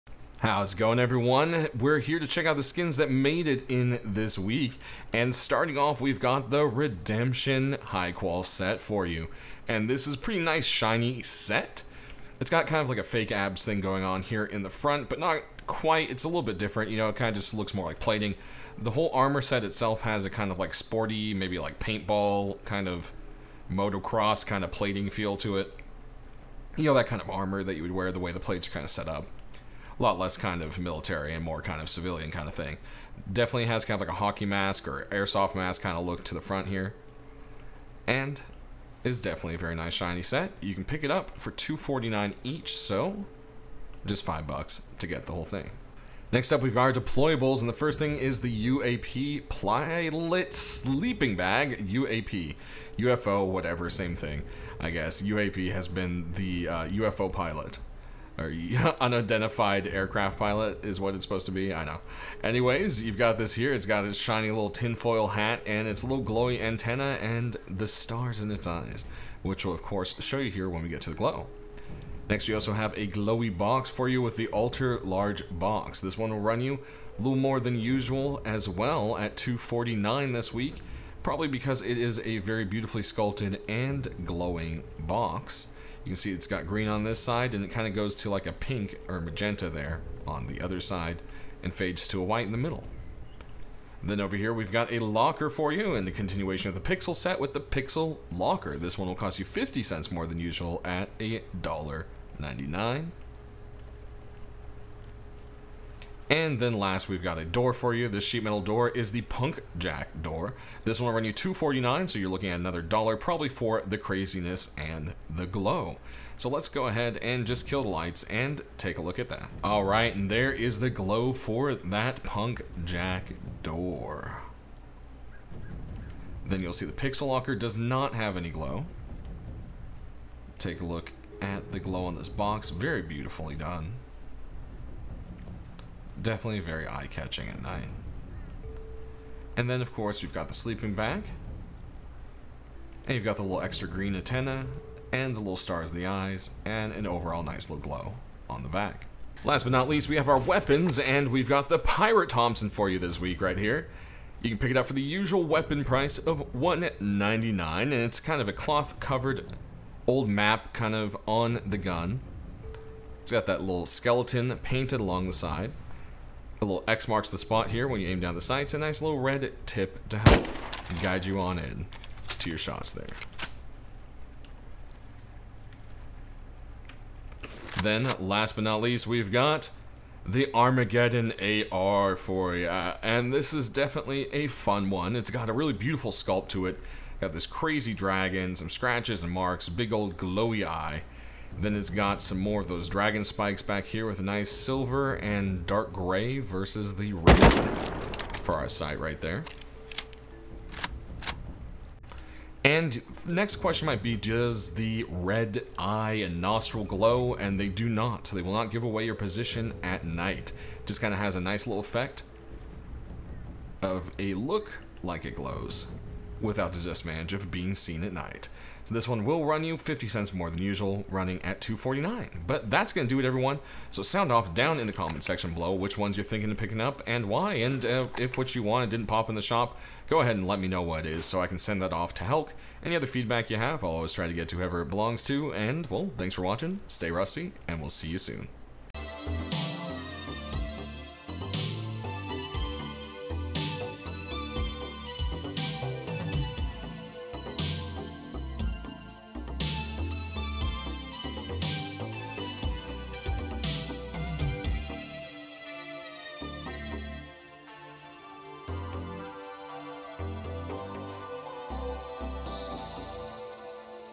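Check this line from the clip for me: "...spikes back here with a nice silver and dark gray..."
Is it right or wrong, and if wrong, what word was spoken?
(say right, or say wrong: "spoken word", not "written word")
right.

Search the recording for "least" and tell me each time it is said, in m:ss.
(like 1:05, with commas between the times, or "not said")
2:29, 2:58.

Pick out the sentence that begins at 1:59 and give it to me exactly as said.
All right, and there is the glow for that Punk Jack door.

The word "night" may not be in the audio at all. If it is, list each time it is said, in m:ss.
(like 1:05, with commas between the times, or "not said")
2:17, 3:30, 3:38.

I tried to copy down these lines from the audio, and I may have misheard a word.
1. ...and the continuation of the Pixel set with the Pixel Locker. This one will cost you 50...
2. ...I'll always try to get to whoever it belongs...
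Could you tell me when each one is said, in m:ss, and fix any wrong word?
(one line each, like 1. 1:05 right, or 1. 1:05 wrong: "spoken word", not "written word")
1. 1:35 right
2. 3:53 right.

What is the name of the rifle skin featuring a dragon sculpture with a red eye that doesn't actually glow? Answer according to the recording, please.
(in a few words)
Armageddon AR.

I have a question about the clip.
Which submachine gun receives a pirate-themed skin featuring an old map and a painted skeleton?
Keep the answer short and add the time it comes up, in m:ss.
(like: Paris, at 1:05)
Thompson, at 2:31.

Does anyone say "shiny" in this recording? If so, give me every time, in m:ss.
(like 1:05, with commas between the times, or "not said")
0:10, 0:39, 1:04.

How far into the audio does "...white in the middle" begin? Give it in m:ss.
1:32.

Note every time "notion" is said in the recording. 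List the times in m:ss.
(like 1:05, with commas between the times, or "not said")
not said.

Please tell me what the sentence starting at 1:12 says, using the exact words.
Next, we also have a glowy box for you with the Altar Large Box.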